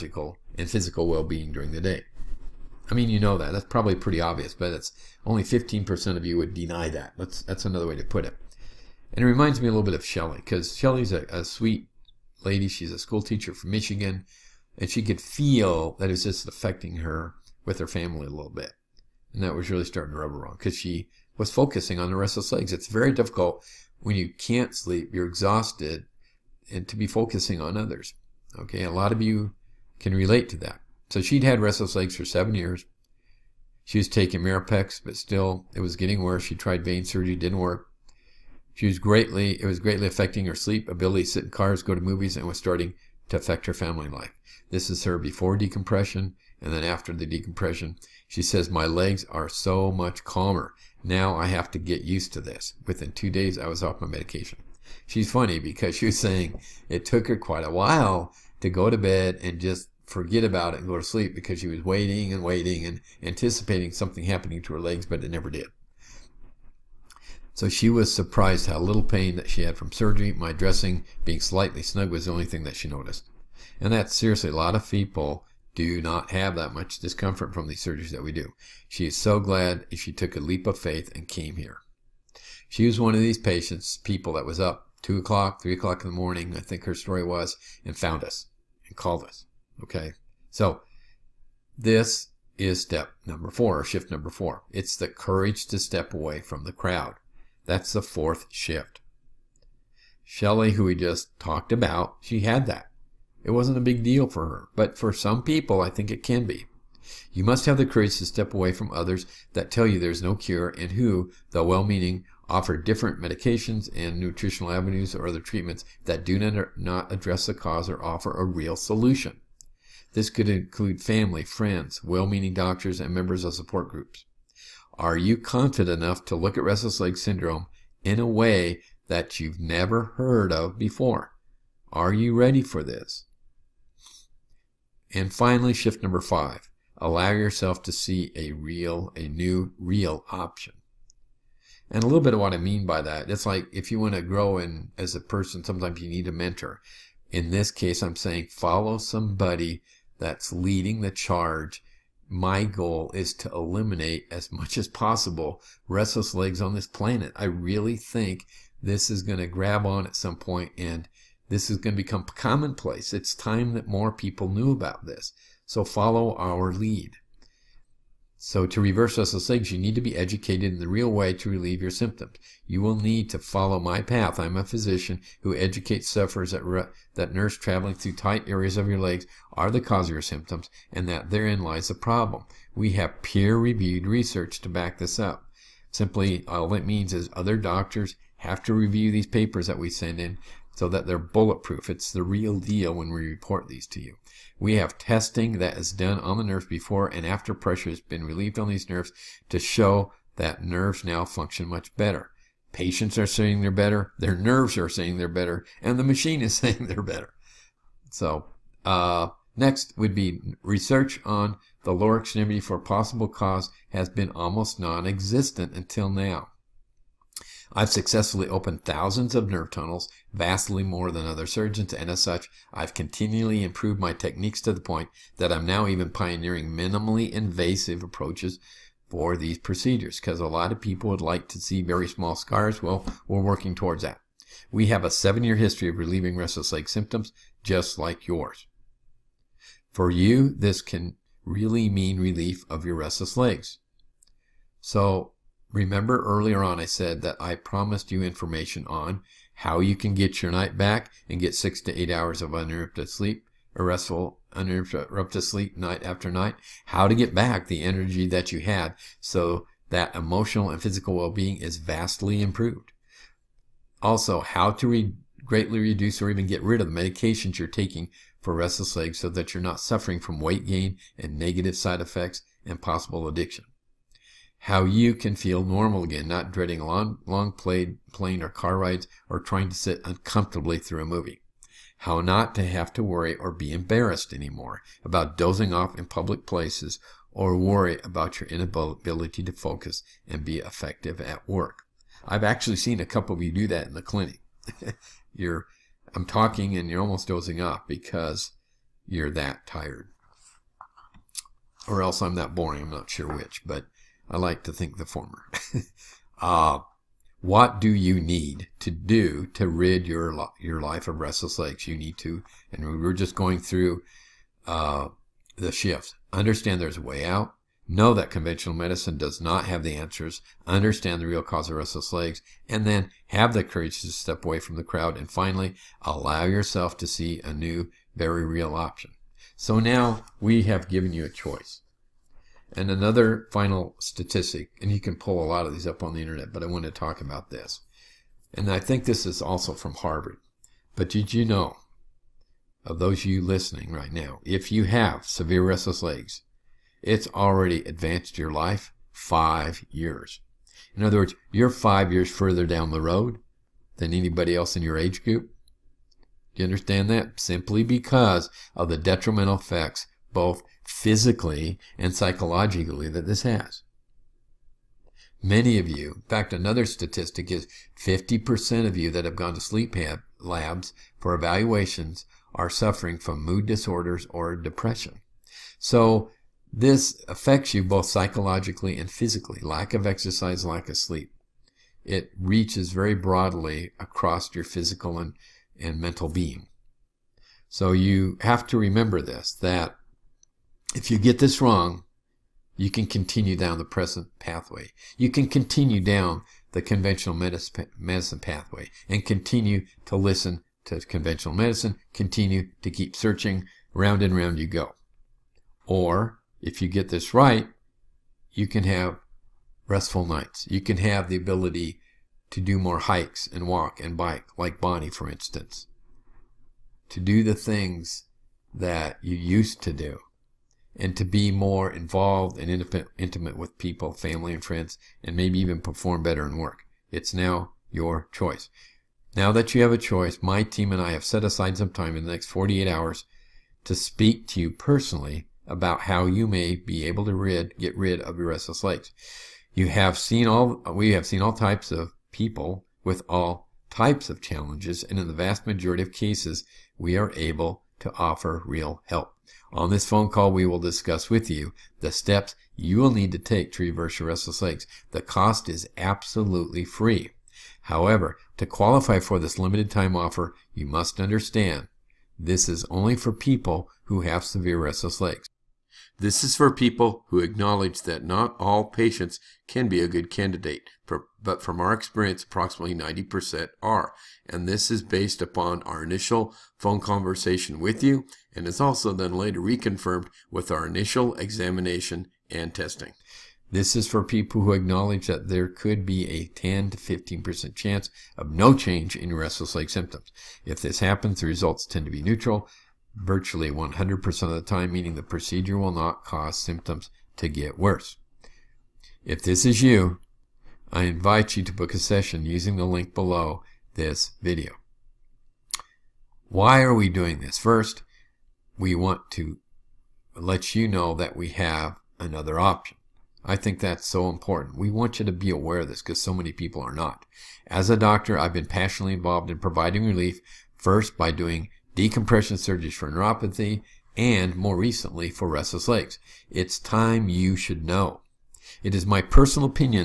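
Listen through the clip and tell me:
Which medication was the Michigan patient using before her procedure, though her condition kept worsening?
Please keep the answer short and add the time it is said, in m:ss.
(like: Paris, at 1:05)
Mirapex, at 0:34.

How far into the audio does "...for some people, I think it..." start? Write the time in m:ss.
1:44.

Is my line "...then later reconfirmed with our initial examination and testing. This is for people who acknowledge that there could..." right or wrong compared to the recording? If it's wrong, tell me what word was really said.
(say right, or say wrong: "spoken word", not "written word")
right.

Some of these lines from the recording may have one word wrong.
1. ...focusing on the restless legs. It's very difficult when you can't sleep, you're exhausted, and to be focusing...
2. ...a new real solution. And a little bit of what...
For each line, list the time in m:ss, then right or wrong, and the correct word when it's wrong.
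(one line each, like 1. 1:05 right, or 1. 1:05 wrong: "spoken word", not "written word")
1. 0:21 right
2. 2:19 wrong: "option", not "solution".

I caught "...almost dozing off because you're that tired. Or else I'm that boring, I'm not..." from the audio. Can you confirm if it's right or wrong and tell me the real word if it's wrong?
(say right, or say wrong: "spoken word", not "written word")
right.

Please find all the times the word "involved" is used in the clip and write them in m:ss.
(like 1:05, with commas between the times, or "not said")
7:01, 8:39.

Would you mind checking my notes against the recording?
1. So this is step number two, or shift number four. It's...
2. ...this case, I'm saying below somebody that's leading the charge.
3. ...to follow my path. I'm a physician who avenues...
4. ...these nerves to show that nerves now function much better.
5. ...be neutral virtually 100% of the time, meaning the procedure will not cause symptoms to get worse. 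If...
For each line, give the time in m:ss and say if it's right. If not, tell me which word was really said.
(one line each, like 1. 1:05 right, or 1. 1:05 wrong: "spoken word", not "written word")
1. 1:30 wrong: "four", not "two"
2. 2:27 wrong: "follow", not "below"
3. 2:53 wrong: "educates", not "avenues"
4. 3:18 right
5. 8:12 right.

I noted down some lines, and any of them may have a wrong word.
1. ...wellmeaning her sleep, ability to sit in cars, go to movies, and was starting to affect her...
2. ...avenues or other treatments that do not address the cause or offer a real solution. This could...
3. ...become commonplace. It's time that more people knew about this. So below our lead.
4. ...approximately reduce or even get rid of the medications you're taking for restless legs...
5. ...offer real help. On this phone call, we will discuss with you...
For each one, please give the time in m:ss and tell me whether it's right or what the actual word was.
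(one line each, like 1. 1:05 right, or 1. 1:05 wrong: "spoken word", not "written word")
1. 0:40 wrong: "affecting", not "wellmeaning"
2. 1:54 right
3. 2:42 wrong: "follow", not "below"
4. 4:25 wrong: "greatly", not "approximately"
5. 7:28 right.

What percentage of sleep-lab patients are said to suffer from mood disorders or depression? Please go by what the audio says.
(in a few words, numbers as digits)
50%.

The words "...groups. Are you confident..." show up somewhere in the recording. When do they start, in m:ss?
2:03.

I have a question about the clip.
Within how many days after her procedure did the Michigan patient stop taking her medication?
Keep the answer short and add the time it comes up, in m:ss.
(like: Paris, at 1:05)
2, at 0:53.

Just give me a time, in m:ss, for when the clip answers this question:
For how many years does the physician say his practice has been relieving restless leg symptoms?
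3:55.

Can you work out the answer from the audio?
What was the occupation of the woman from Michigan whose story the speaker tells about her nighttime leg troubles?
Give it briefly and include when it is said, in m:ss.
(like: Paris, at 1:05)
School teacher, at 0:12.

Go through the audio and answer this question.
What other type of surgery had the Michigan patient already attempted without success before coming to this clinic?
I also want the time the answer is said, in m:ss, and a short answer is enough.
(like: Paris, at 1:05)
Vein surgery, at 0:36.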